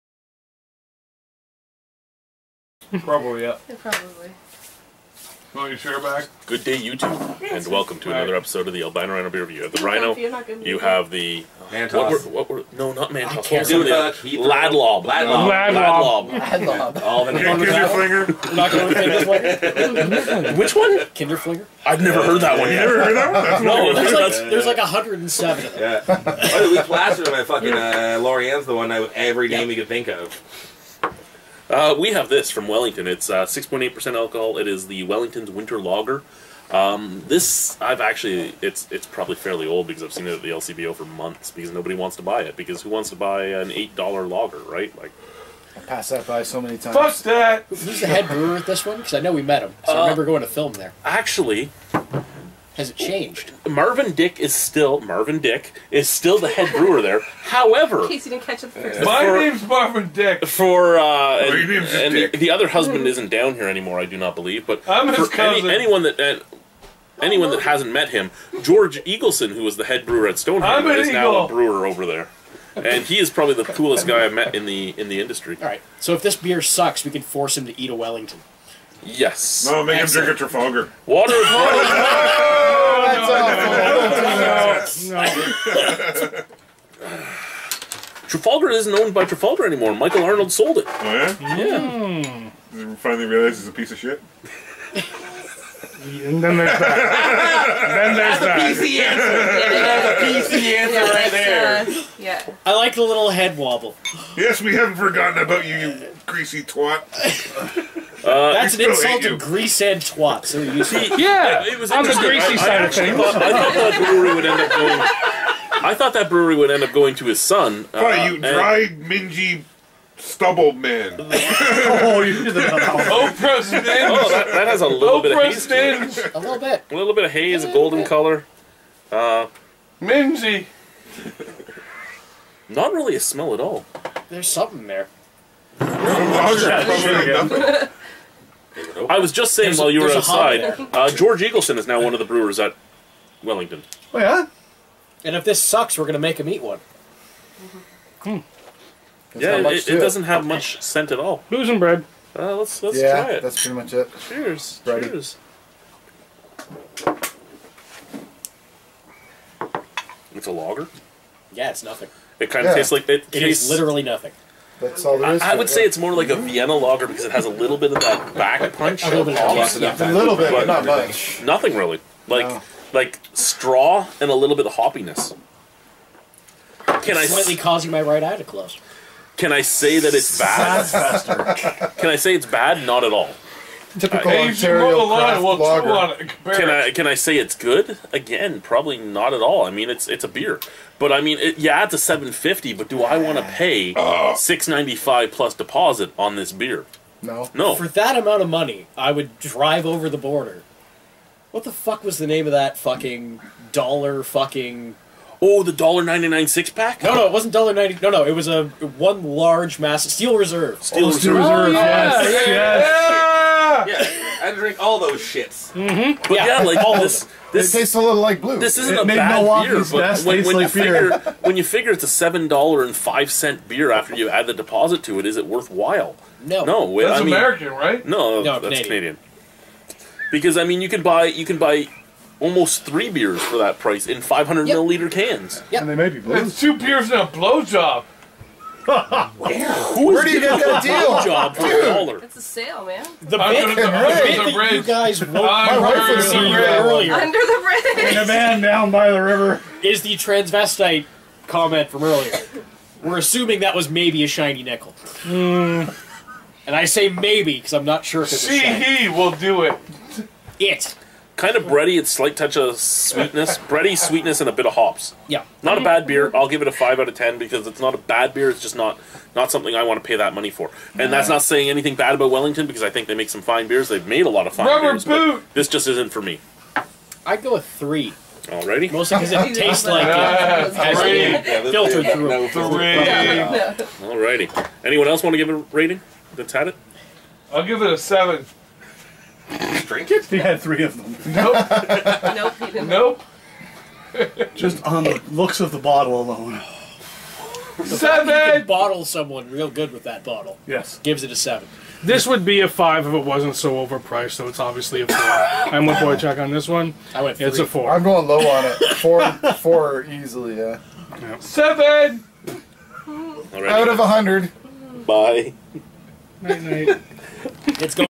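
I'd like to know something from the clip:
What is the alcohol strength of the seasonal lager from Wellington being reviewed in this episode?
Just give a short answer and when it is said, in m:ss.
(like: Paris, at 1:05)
6.8%, at 0:33.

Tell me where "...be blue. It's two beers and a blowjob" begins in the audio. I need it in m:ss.
3:56.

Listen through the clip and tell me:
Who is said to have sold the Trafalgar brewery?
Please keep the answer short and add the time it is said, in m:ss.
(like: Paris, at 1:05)
Michael Arnold, at 1:29.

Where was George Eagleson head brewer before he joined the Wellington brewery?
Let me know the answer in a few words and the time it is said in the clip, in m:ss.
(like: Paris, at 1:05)
Stone Hammer, at 1:10.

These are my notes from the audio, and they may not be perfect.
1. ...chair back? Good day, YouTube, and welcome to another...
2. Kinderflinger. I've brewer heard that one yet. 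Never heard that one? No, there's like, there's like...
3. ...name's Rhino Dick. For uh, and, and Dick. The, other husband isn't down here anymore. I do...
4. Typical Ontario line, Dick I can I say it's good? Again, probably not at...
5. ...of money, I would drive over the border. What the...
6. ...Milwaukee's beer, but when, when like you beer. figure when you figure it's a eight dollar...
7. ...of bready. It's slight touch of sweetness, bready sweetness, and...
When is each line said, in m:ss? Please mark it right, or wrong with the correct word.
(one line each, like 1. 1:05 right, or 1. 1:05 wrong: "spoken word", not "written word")
1. 0:05 right
2. 0:21 wrong: "never", not "brewer"
3. 0:59 wrong: "Marvin", not "Rhino"
4. 3:03 wrong: "Can", not "Dick"
5. 3:18 right
6. 3:39 wrong: "seven", not "eight"
7. 4:21 right.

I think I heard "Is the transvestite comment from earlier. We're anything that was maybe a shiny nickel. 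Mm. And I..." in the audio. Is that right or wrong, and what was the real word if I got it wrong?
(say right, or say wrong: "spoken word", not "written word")
wrong: "assuming", not "anything".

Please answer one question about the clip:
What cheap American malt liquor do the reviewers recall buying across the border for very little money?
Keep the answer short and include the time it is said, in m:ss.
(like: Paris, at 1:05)
Steel Reserve, at 3:30.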